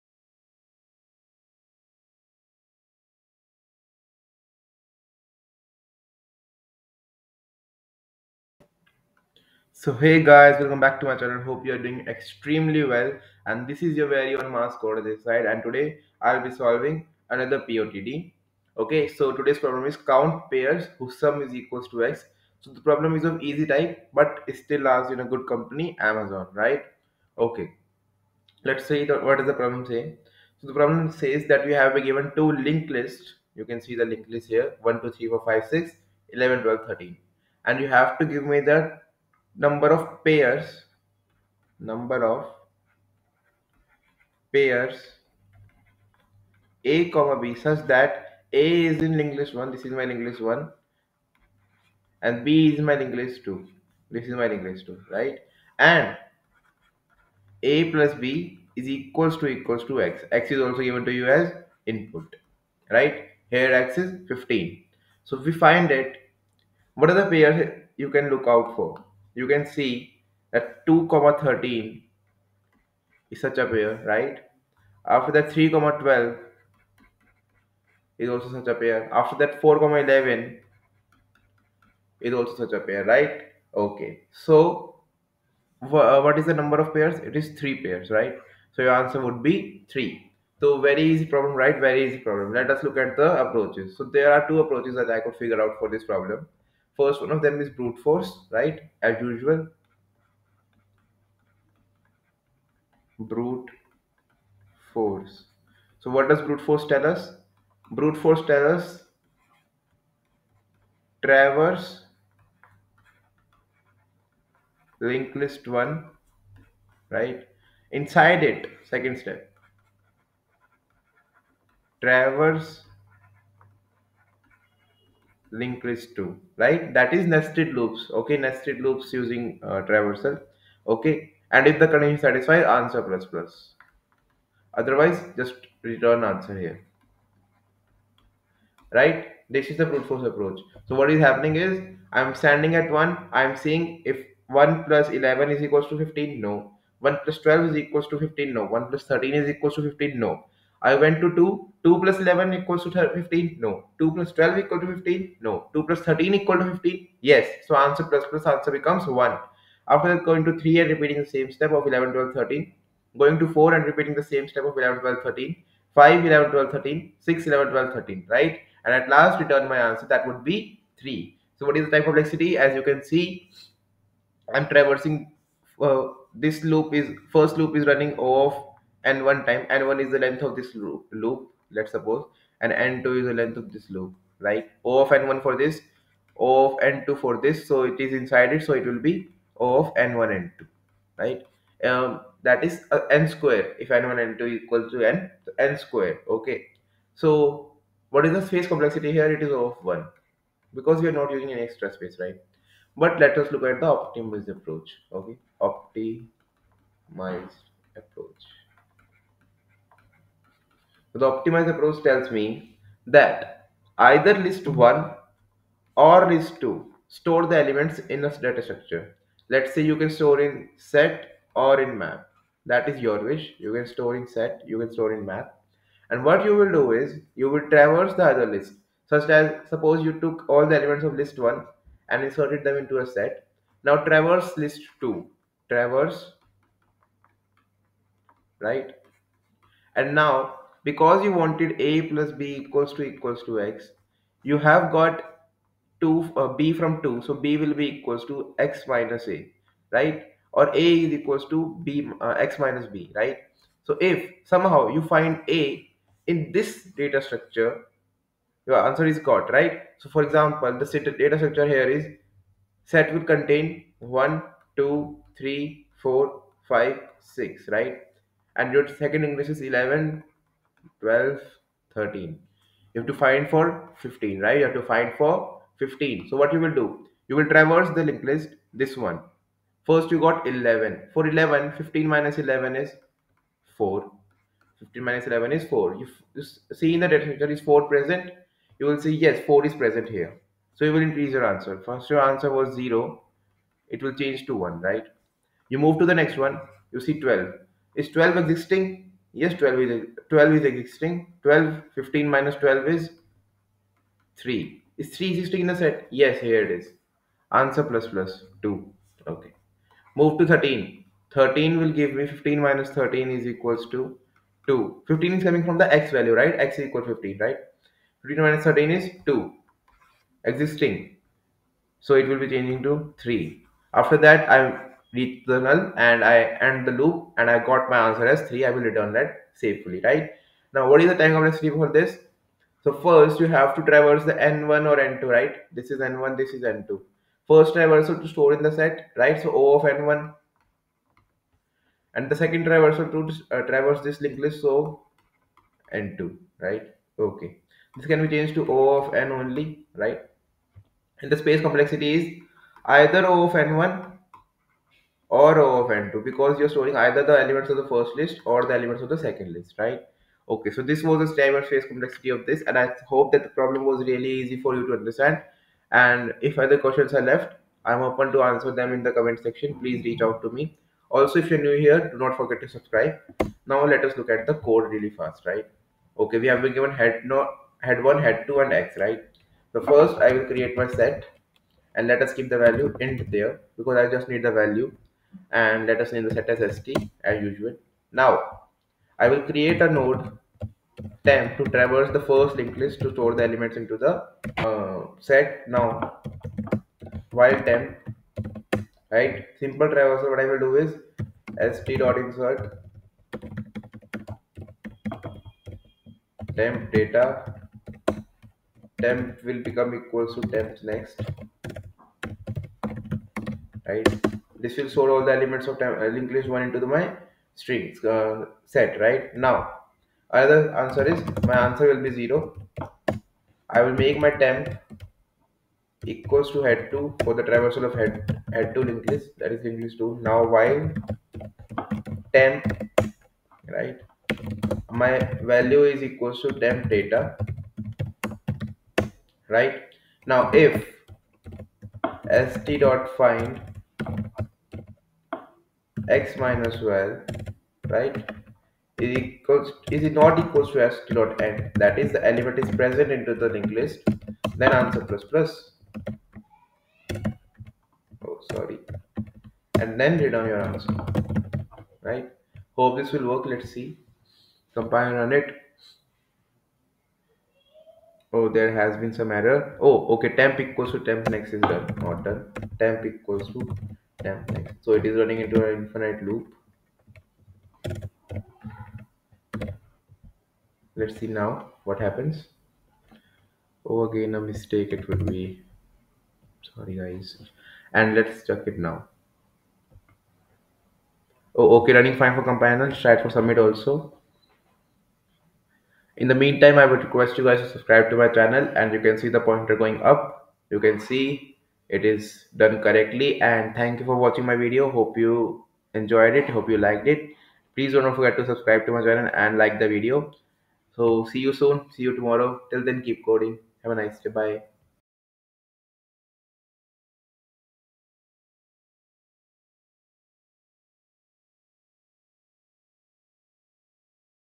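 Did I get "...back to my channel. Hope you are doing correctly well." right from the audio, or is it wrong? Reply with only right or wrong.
wrong.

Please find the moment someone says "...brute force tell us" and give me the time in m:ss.
1:46.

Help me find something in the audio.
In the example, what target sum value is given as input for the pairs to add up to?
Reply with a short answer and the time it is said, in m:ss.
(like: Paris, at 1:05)
15, at 1:03.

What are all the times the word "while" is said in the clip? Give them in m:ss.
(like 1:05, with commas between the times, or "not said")
6:37, 7:10.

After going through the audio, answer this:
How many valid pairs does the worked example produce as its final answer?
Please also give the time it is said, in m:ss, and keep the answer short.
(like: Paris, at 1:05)
3, at 1:27.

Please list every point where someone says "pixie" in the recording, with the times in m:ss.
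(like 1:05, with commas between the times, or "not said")
not said.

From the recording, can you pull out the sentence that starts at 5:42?
And the second traversal to uh, traverse this linked list, so N2, right?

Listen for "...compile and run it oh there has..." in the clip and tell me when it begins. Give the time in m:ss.
7:44.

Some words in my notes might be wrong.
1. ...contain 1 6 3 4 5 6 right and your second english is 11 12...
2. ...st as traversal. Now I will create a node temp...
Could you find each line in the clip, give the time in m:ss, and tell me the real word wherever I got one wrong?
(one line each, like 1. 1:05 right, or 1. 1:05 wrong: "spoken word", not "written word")
1. 4:23 wrong: "2", not "6"
2. 6:26 wrong: "usual", not "traversal".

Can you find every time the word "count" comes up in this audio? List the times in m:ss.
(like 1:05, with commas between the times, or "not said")
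0:19.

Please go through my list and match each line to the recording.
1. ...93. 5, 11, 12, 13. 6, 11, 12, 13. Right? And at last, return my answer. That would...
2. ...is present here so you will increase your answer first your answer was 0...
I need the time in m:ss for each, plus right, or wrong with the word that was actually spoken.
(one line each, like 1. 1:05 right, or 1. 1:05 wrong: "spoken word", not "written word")
1. 2:45 wrong: "13", not "93"
2. 4:49 right.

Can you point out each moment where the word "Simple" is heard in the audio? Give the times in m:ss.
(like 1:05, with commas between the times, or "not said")
6:39.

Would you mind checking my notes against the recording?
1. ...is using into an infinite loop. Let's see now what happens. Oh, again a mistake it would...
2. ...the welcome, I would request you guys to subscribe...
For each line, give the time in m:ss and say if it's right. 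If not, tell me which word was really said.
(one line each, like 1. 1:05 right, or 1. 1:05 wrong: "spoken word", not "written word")
1. 7:55 wrong: "running", not "using"
2. 8:16 wrong: "meantime", not "welcome".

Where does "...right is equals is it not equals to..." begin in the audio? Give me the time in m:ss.
7:27.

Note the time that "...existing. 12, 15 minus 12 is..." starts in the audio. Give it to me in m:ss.
5:00.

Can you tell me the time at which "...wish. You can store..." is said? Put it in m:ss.
3:43.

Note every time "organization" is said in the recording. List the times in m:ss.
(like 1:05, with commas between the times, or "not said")
not said.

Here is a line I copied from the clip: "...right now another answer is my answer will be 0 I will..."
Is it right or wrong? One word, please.
right.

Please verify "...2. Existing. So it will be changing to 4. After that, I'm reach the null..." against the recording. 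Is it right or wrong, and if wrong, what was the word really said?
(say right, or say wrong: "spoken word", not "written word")
wrong: "3", not "4".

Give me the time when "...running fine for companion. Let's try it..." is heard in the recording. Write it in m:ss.
8:11.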